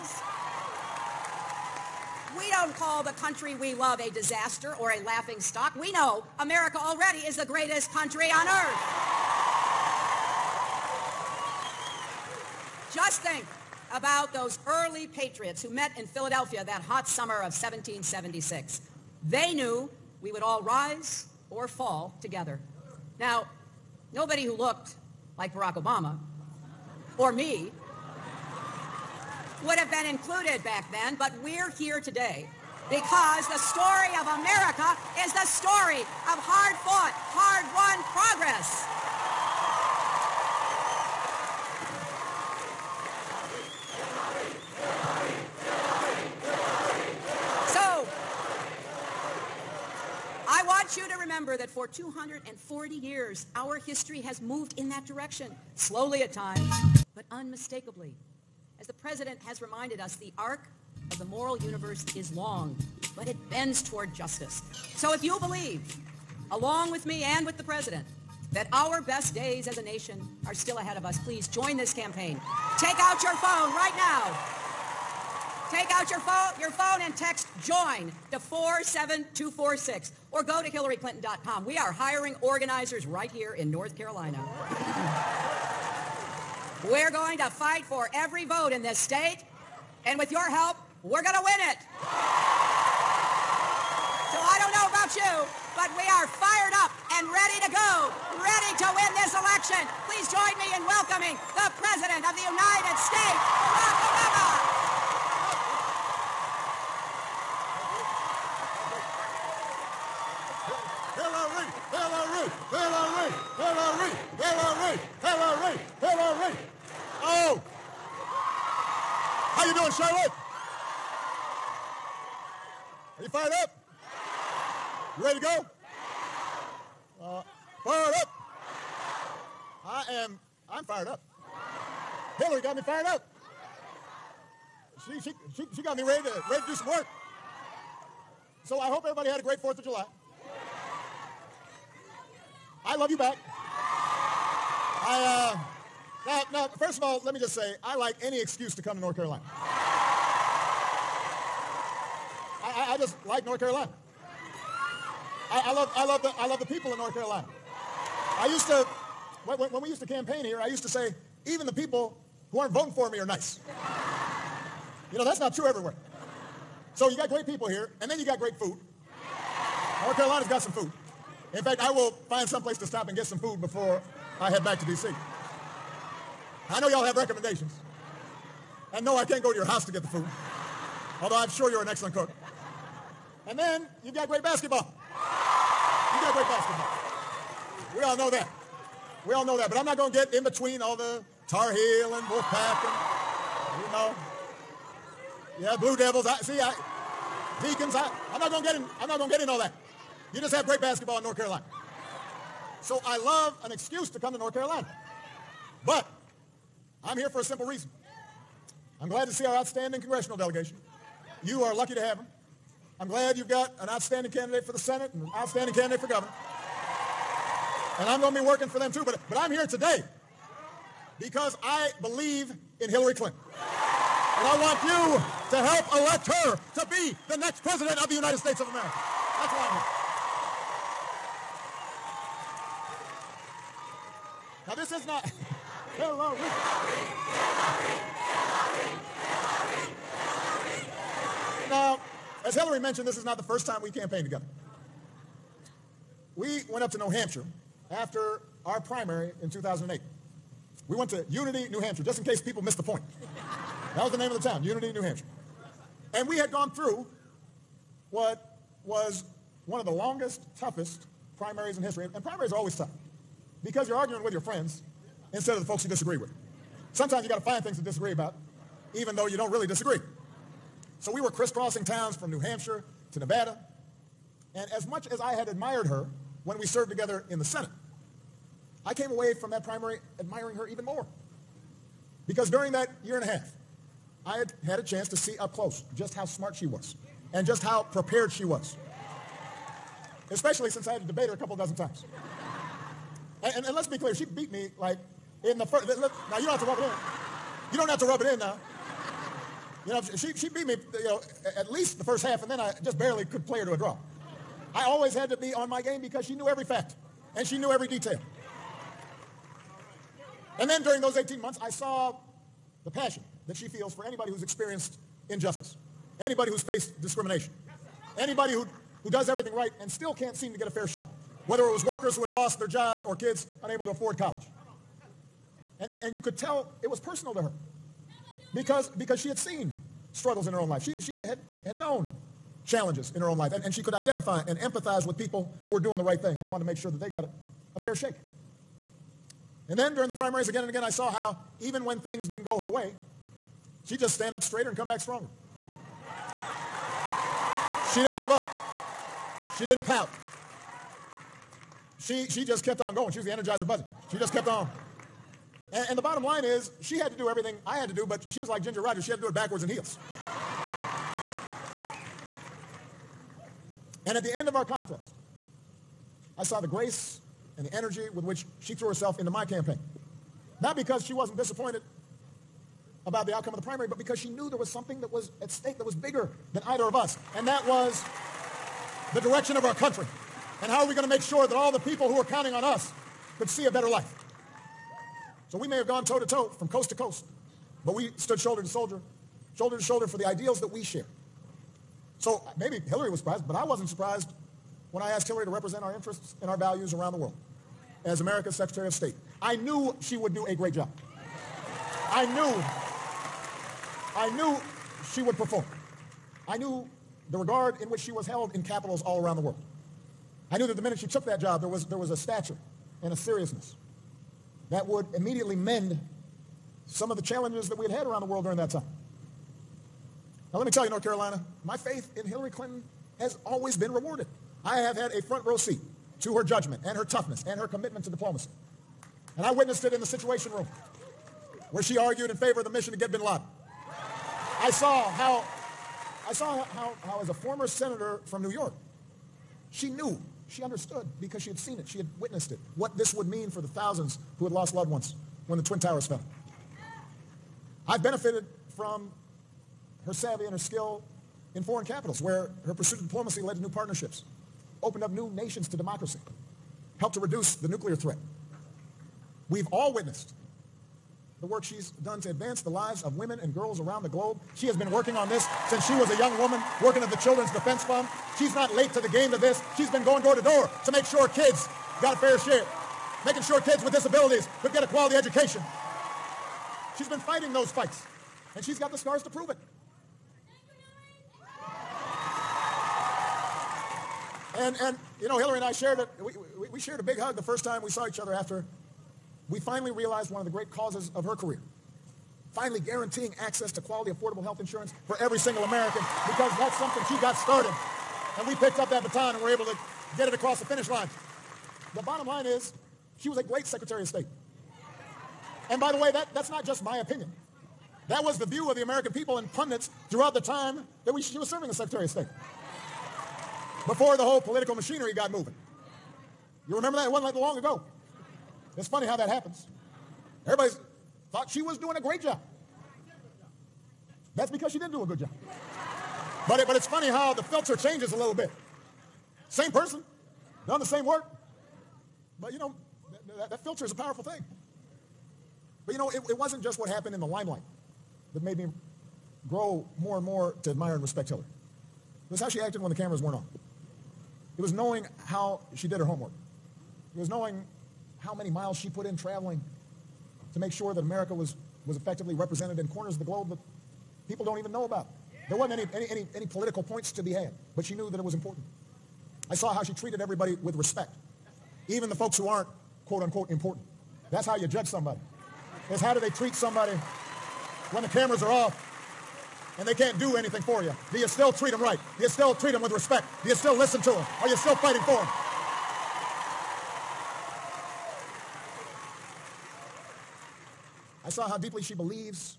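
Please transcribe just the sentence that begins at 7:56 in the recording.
She's been fighting those fights, and she's got the scars to prove it.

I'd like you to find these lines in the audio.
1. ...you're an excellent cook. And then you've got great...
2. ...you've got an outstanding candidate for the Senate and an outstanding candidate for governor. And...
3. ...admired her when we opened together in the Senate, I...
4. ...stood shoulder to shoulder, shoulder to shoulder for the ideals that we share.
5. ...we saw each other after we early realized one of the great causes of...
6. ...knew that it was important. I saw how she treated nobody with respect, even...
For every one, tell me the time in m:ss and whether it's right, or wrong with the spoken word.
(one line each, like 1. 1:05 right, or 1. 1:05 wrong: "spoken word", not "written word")
1. 3:01 right
2. 3:33 right
3. 4:35 wrong: "served", not "opened"
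4. 6:28 right
5. 8:07 wrong: "finally", not "early"
6. 9:17 wrong: "everybody", not "nobody".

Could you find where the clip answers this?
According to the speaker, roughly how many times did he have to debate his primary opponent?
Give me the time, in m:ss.
4:51.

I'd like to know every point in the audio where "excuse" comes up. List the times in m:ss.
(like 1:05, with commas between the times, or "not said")
2:28, 3:23.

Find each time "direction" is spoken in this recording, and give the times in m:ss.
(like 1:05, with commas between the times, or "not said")
0:55, 6:19.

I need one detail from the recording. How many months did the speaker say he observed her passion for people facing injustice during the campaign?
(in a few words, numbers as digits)
18.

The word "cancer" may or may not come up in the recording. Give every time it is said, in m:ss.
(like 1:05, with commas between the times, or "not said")
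not said.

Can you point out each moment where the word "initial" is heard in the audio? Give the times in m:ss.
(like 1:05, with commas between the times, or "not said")
not said.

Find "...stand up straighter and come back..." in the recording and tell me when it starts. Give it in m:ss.
5:44.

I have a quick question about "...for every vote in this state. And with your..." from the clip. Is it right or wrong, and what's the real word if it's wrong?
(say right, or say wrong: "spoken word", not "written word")
right.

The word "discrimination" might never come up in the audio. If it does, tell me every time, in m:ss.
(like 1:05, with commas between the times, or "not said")
5:17.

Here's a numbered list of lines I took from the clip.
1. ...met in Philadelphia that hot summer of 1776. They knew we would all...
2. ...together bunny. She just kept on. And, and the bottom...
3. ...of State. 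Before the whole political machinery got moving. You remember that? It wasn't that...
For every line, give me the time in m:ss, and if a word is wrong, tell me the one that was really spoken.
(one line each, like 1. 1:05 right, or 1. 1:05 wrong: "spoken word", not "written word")
1. 0:15 right
2. 5:53 wrong: "energizer", not "together"
3. 8:32 right.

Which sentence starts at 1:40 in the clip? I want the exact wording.
Please join me in welcoming the President of the United States.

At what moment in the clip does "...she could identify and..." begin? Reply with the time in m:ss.
5:33.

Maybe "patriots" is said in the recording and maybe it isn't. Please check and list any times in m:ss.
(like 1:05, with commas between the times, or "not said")
0:15.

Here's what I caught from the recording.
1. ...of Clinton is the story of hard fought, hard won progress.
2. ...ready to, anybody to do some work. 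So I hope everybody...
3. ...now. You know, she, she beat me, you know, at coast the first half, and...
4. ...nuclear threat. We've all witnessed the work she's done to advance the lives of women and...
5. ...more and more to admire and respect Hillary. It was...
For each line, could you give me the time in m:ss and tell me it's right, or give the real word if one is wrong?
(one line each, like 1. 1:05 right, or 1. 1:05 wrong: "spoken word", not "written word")
1. 0:34 wrong: "America", not "Clinton"
2. 2:16 wrong: "ready", not "anybody"
3. 4:58 wrong: "least", not "coast"
4. 7:37 right
5. 8:59 right.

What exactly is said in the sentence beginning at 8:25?
And by the way, that, that's not just my opinion.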